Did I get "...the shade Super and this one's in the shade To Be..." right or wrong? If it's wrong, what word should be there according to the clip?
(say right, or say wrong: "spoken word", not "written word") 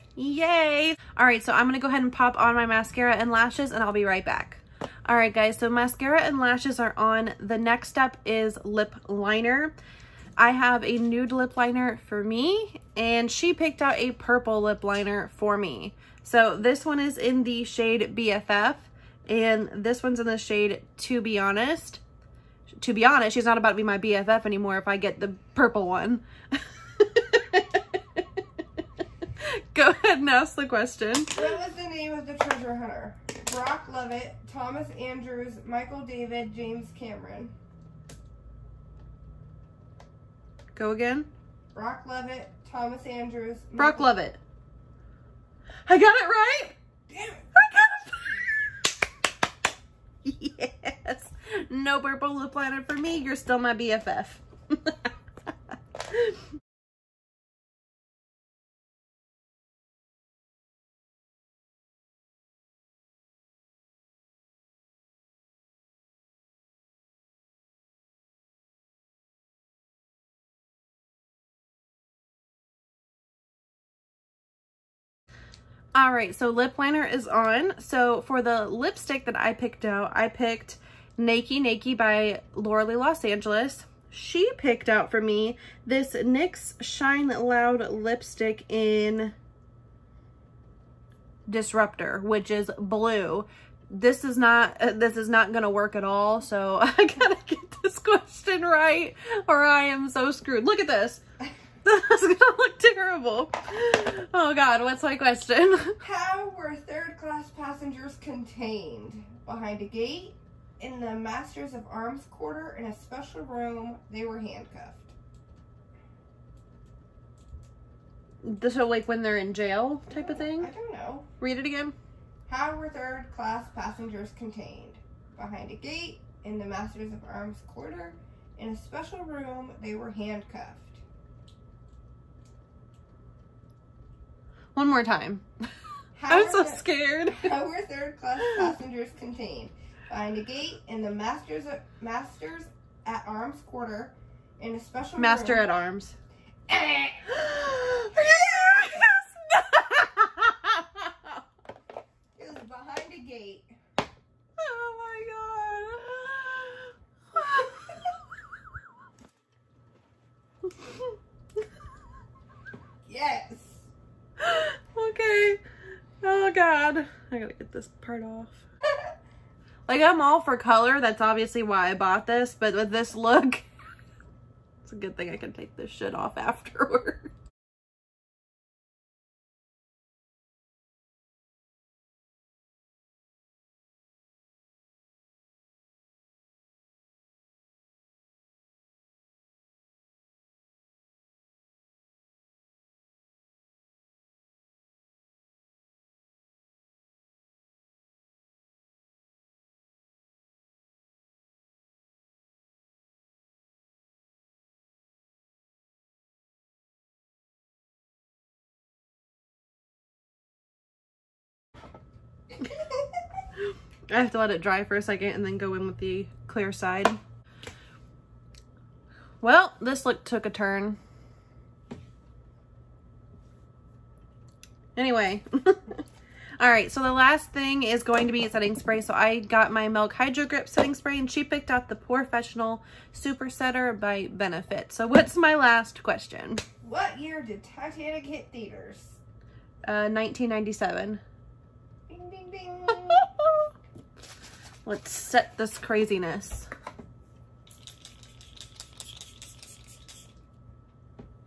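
wrong: "BFF", not "Super".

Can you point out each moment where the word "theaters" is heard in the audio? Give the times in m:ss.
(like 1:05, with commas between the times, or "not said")
3:58.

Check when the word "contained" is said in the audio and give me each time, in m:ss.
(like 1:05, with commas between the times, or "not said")
1:48, 2:04, 2:19.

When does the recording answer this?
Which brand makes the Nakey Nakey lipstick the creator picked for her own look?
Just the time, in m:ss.
1:22.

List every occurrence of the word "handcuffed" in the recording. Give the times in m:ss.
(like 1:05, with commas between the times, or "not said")
1:54, 2:10.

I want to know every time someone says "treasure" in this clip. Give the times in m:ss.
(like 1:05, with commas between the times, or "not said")
0:32.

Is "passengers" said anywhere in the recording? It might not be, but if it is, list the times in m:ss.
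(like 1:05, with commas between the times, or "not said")
1:47, 2:03, 2:18.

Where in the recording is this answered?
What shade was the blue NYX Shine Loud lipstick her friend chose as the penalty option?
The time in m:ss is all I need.
1:31.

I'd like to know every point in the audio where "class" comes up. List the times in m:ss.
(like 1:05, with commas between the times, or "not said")
1:47, 2:03, 2:18.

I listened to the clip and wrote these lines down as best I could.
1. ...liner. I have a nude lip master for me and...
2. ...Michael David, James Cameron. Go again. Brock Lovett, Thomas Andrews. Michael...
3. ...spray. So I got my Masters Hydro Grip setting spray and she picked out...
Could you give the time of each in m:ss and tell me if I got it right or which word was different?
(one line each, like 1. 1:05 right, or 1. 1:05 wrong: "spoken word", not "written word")
1. 0:09 wrong: "liner", not "master"
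2. 0:35 right
3. 3:48 wrong: "Milk", not "Masters".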